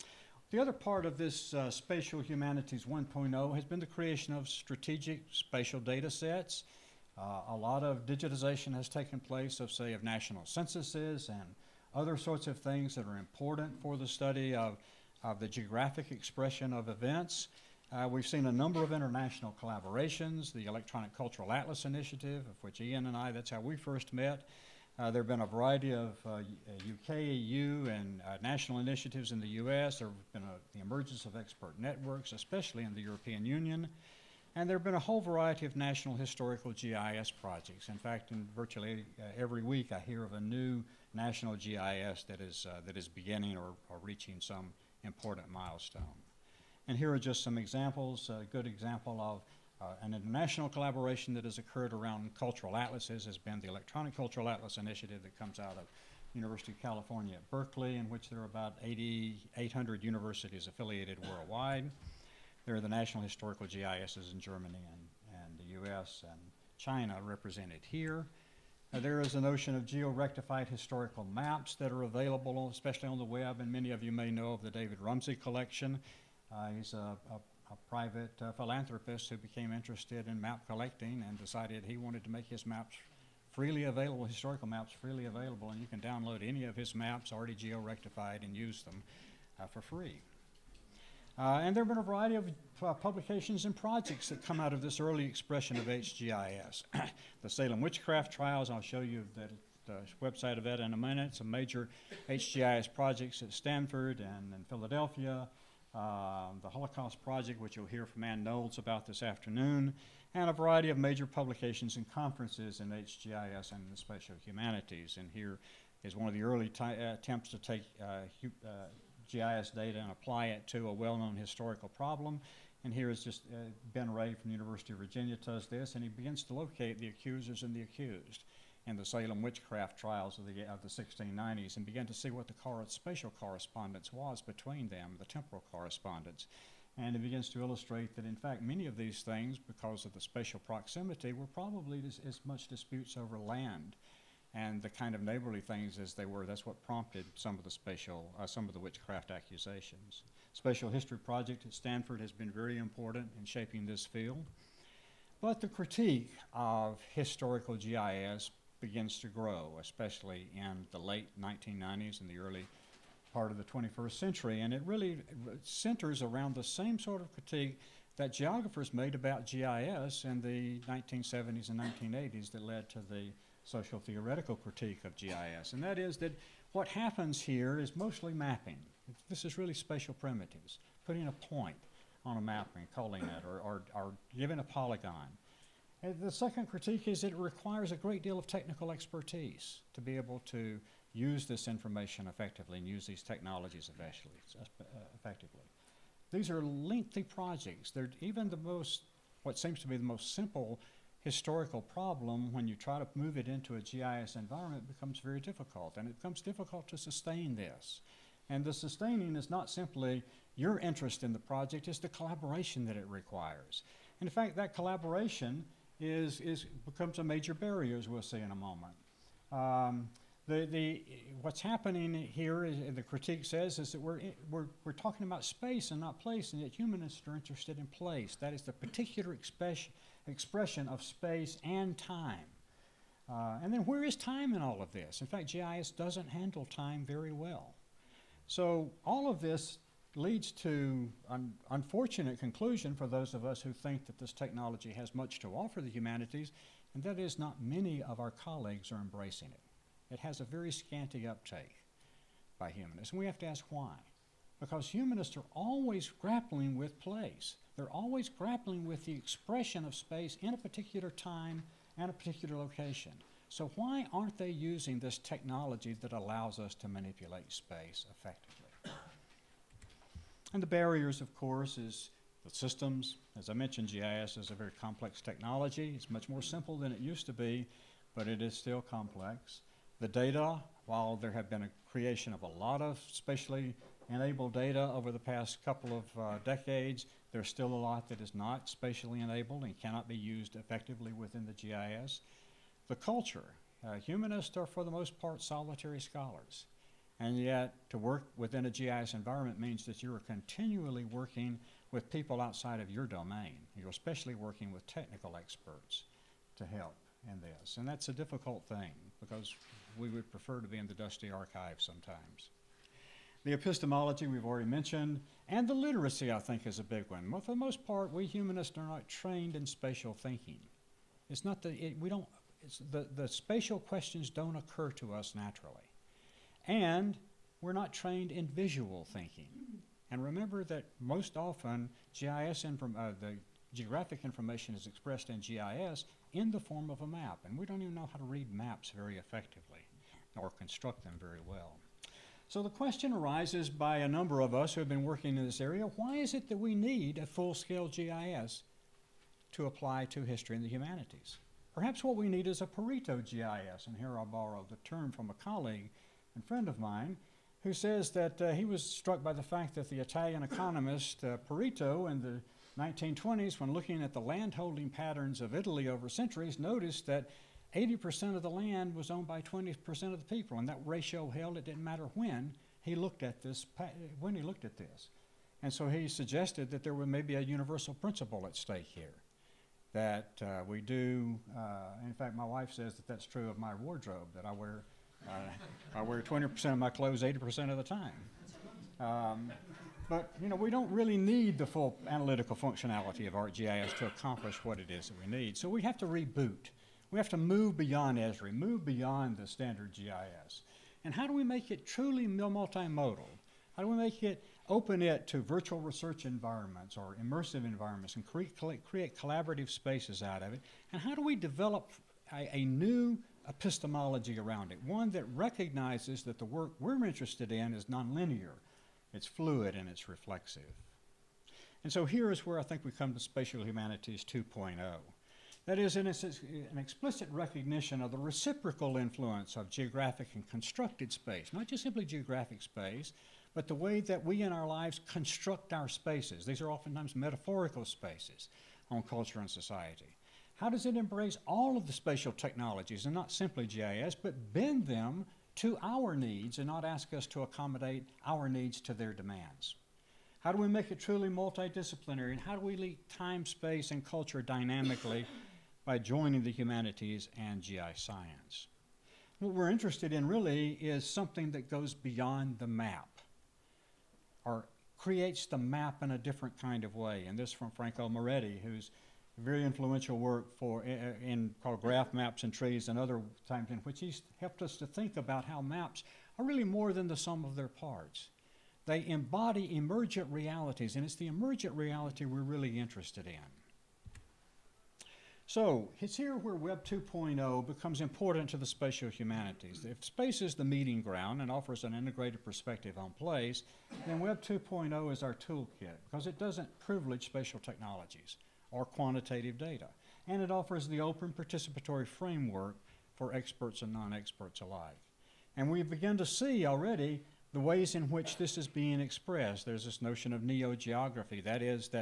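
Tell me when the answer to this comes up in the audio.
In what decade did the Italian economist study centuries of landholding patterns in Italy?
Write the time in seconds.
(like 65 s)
362 s.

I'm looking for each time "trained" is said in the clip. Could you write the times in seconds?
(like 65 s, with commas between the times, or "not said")
319 s, 327 s.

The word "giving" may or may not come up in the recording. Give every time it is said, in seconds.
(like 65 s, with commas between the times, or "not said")
184 s.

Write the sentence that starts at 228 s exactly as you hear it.
That is the particular expression, expression of space and time.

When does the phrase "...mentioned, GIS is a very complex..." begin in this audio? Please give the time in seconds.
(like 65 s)
273 s.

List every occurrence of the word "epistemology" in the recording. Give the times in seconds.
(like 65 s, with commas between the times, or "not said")
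313 s, 413 s.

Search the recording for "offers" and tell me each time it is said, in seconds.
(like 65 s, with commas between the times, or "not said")
245 s, 491 s, 500 s.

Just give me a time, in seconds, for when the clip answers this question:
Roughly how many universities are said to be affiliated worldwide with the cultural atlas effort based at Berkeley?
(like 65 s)
58 s.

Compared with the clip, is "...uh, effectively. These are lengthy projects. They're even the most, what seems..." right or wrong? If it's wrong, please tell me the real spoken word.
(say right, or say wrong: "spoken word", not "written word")
right.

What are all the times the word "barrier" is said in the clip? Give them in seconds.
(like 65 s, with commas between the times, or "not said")
217 s, 270 s.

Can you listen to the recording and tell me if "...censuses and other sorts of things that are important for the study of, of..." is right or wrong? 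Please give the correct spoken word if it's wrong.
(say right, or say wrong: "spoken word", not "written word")
right.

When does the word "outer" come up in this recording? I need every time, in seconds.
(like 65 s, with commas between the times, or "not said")
not said.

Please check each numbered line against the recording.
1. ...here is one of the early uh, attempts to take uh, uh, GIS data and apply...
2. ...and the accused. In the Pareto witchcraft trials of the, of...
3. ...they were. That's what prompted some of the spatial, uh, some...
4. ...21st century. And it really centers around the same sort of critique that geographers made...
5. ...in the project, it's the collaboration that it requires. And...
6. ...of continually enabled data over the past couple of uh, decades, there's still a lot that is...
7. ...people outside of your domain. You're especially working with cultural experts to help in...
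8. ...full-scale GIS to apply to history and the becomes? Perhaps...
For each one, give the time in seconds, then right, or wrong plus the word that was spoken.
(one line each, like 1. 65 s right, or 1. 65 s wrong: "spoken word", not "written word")
1. 115 s right
2. 127 s wrong: "Salem", not "Pareto"
3. 146 s right
4. 163 s right
5. 211 s right
6. 282 s wrong: "spatially", not "continually"
7. 302 s wrong: "technical", not "cultural"
8. 347 s wrong: "humanities", not "becomes".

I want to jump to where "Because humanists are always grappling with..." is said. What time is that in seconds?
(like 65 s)
254 s.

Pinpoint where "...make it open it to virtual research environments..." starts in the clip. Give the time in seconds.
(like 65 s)
403 s.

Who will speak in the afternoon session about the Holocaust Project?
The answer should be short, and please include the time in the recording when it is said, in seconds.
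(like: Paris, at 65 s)
Anne Knowles, at 108 s.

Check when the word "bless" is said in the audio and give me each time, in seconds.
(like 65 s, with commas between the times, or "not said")
not said.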